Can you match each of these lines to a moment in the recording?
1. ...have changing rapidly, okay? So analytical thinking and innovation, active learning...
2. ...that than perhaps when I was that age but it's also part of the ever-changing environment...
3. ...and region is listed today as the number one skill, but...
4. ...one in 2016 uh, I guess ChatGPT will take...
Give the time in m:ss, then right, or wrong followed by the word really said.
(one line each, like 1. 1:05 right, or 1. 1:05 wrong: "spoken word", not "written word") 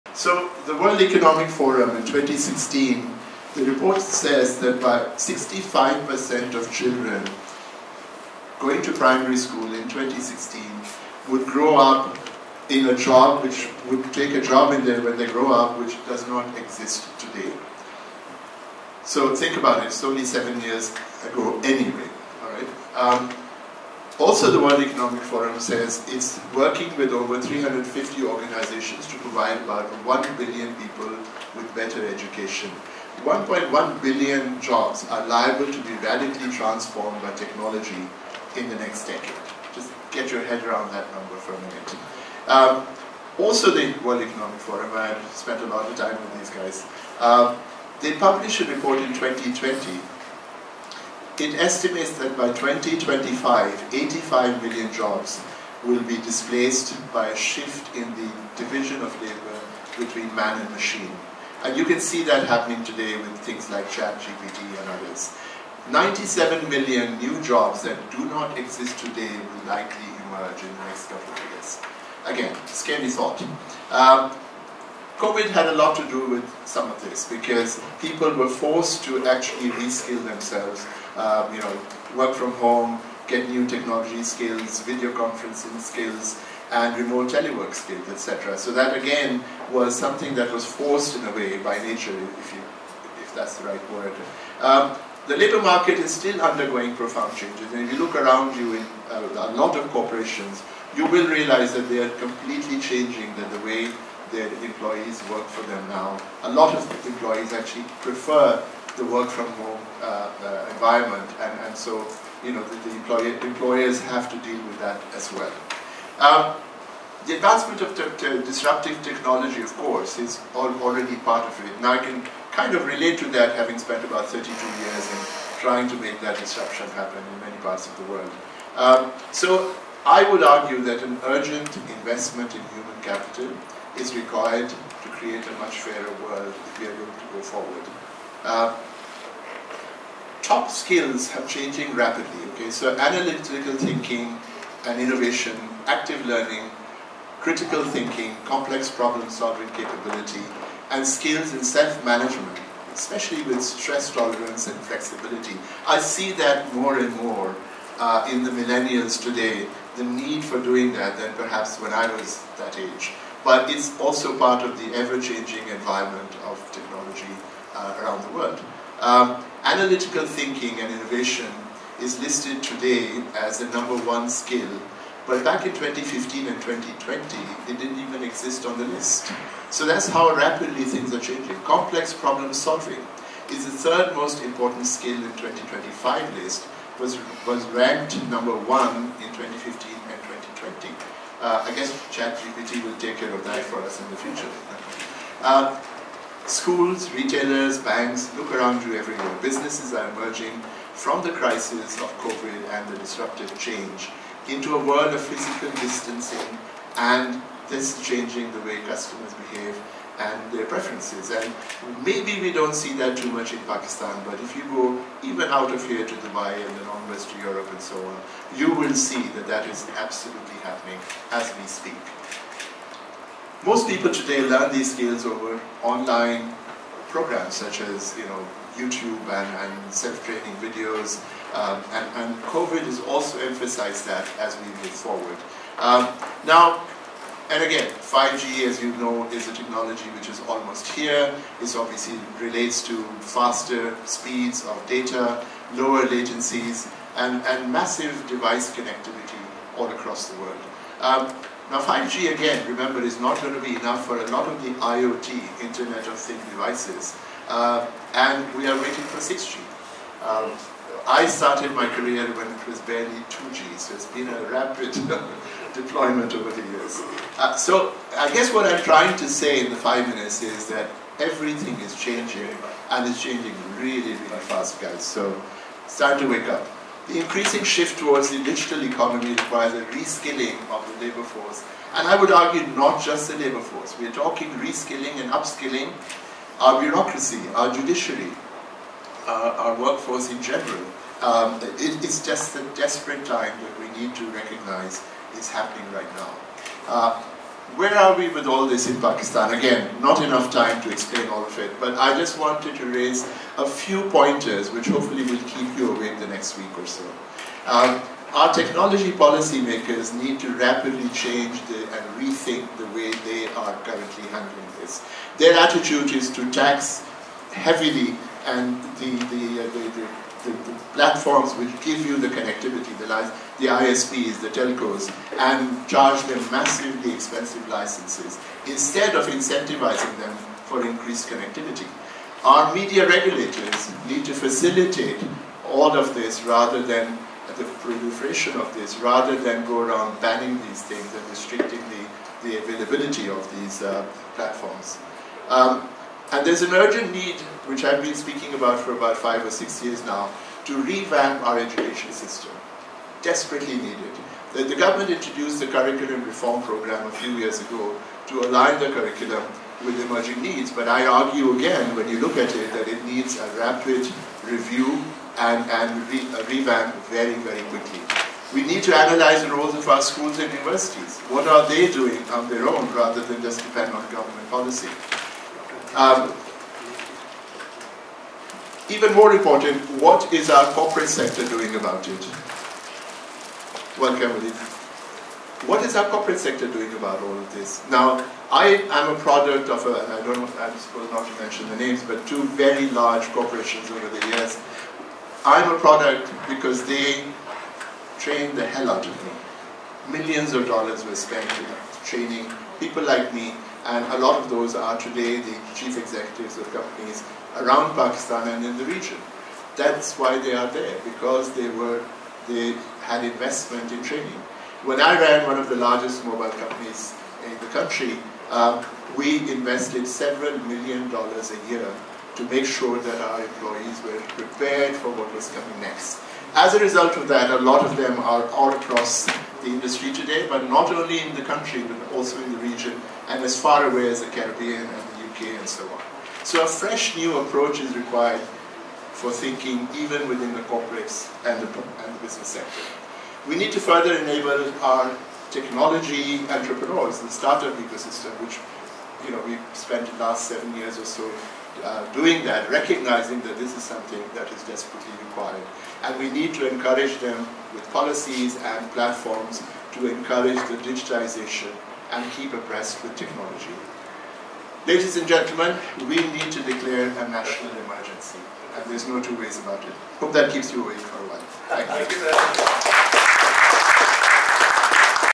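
1. 2:21 right
2. 2:40 right
3. 2:50 wrong: "innovation", not "region"
4. 3:08 wrong: "2015", not "2016".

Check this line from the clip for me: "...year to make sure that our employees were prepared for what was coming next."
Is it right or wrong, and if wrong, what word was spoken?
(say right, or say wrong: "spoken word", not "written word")
right.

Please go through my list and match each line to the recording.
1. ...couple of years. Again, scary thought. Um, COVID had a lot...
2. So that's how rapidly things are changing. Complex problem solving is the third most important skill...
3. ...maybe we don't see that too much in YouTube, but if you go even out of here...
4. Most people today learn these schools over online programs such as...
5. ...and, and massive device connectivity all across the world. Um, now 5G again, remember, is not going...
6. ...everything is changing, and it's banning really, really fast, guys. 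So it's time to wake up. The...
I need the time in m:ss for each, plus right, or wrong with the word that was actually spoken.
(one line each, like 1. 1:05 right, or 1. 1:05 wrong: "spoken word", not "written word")
1. 1:11 right
2. 2:59 right
3. 3:32 wrong: "Pakistan", not "YouTube"
4. 3:43 wrong: "skills", not "schools"
5. 4:07 right
6. 4:31 wrong: "changing", not "banning".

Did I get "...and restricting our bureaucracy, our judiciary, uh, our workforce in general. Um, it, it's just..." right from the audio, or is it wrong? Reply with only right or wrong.
wrong.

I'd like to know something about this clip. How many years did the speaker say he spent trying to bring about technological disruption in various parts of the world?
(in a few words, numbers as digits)
32 years.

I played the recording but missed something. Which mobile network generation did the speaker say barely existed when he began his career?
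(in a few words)
2G.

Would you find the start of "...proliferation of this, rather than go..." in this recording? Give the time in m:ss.
5:37.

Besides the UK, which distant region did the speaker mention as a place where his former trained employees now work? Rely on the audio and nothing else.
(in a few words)
the Caribbean.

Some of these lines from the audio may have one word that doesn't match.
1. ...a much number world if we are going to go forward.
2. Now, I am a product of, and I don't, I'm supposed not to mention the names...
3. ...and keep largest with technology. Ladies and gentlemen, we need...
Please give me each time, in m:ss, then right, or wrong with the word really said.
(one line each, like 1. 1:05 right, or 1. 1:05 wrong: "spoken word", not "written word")
1. 2:15 wrong: "fairer", not "number"
2. 6:27 right
3. 7:42 wrong: "abreast", not "largest".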